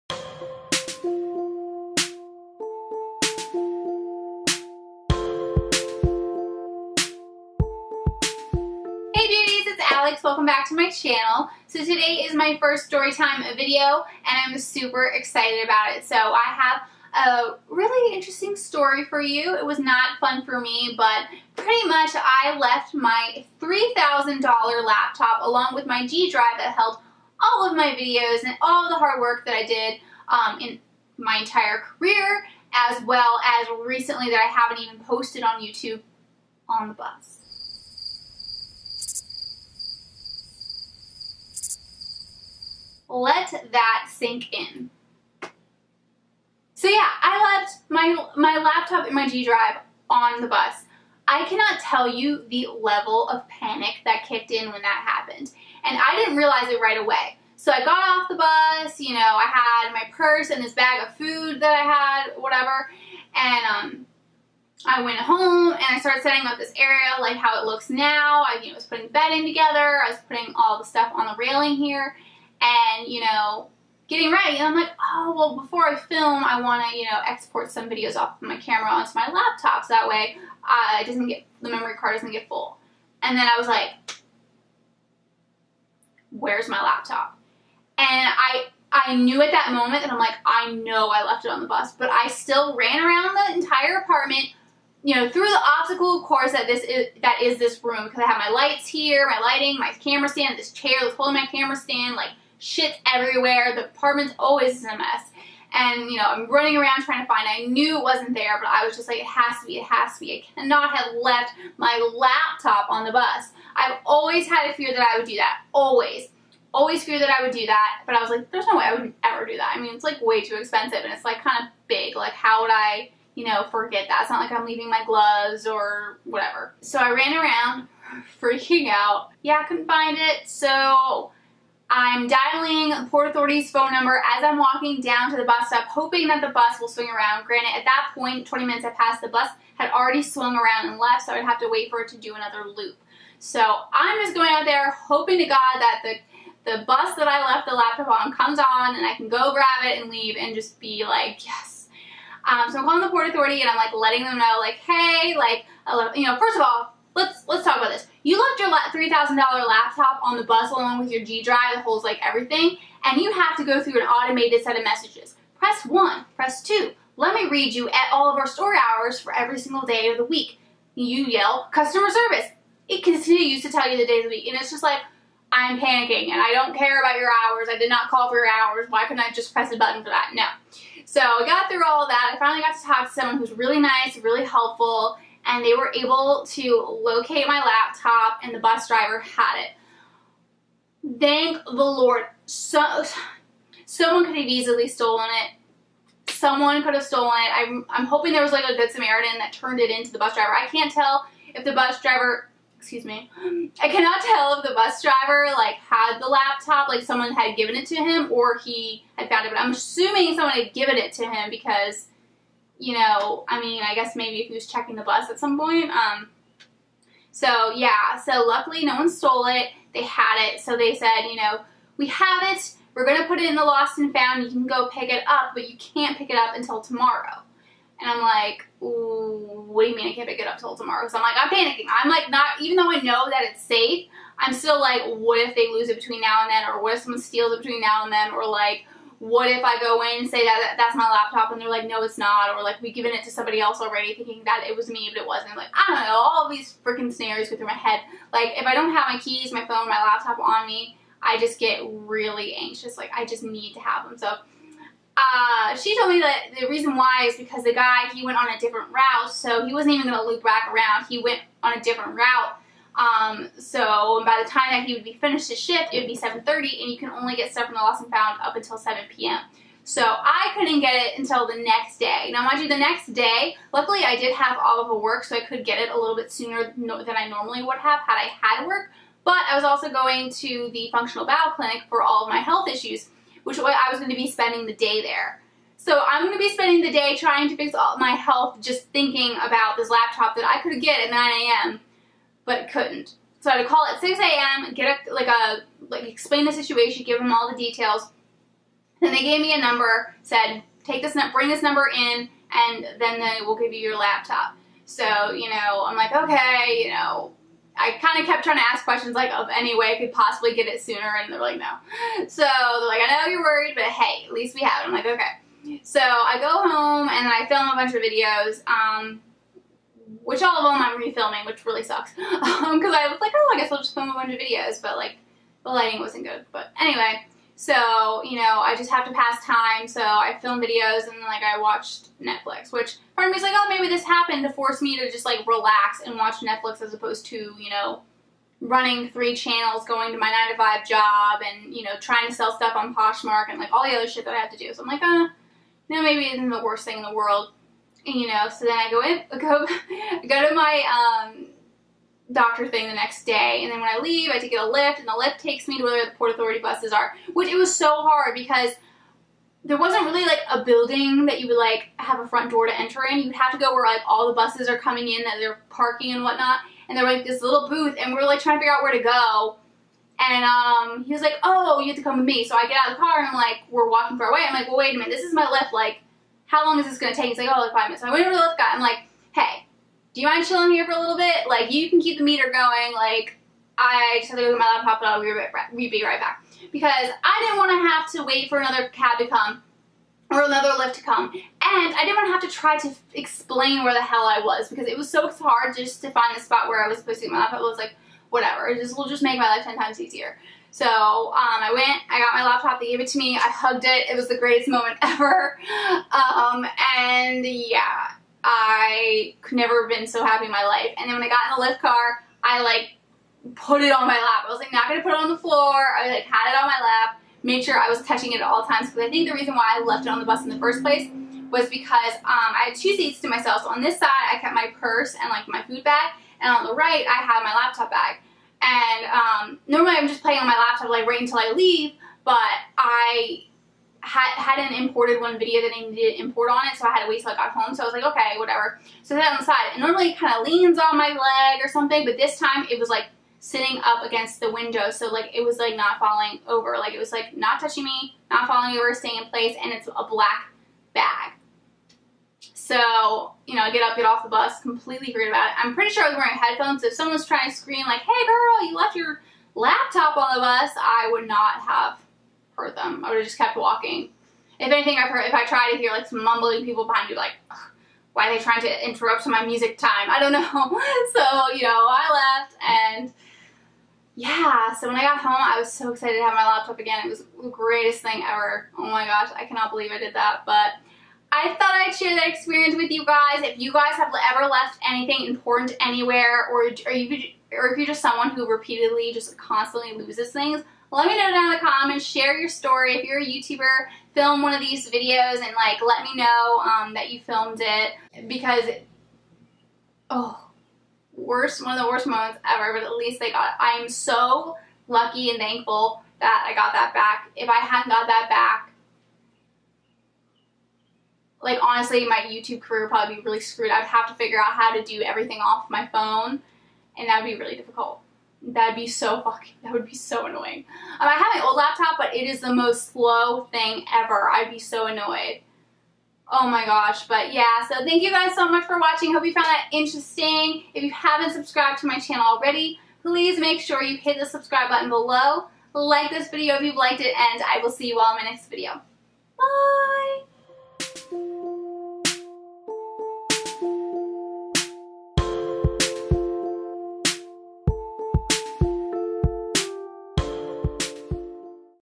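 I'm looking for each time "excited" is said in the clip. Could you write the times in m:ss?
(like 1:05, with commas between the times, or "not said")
0:15, 7:55.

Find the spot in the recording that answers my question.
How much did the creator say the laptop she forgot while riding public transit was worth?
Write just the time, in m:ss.
0:23.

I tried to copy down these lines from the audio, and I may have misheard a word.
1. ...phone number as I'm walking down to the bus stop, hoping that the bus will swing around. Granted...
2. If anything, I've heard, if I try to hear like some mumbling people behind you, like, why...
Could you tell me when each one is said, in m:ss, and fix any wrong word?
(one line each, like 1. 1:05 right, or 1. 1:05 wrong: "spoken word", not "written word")
1. 2:13 right
2. 7:44 right.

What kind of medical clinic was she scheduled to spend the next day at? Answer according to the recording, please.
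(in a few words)
functional bowel clinic.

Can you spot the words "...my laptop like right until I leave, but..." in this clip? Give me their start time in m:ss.
7:10.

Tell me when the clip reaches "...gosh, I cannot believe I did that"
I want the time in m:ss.
7:59.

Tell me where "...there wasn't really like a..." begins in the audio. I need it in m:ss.
5:59.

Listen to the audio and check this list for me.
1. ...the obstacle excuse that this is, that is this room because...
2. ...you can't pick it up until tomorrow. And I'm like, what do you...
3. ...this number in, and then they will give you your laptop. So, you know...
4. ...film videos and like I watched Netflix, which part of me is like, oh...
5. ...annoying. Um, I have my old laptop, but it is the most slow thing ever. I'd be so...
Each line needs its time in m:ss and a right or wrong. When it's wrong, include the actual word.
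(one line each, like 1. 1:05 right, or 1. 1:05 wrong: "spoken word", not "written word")
1. 1:35 wrong: "course", not "excuse"
2. 3:45 right
3. 5:01 right
4. 5:30 right
5. 8:40 right.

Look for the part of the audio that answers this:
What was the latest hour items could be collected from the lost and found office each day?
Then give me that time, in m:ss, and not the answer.
4:28.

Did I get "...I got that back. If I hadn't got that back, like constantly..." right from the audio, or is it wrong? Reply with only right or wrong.
wrong.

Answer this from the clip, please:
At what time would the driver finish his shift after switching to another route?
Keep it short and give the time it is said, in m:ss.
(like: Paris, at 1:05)
7:30, at 4:26.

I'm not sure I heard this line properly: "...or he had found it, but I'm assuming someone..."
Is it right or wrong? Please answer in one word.
right.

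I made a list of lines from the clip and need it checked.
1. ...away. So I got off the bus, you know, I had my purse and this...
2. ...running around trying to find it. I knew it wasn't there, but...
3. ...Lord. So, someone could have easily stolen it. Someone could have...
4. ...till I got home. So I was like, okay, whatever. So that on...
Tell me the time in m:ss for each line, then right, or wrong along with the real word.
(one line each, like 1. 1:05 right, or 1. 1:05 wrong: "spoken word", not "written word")
1. 0:56 right
2. 1:46 right
3. 3:11 right
4. 7:17 right.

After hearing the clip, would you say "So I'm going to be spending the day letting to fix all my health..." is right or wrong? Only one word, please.
wrong.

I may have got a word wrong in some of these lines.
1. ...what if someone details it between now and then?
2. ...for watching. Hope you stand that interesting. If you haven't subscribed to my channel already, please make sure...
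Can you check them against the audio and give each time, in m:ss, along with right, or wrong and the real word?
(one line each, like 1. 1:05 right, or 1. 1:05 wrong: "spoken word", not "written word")
1. 3:56 wrong: "steals", not "details"
2. 8:48 wrong: "found", not "stand".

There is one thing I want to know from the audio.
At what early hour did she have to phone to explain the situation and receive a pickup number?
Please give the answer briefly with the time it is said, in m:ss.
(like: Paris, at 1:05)
6 a.m., at 4:53.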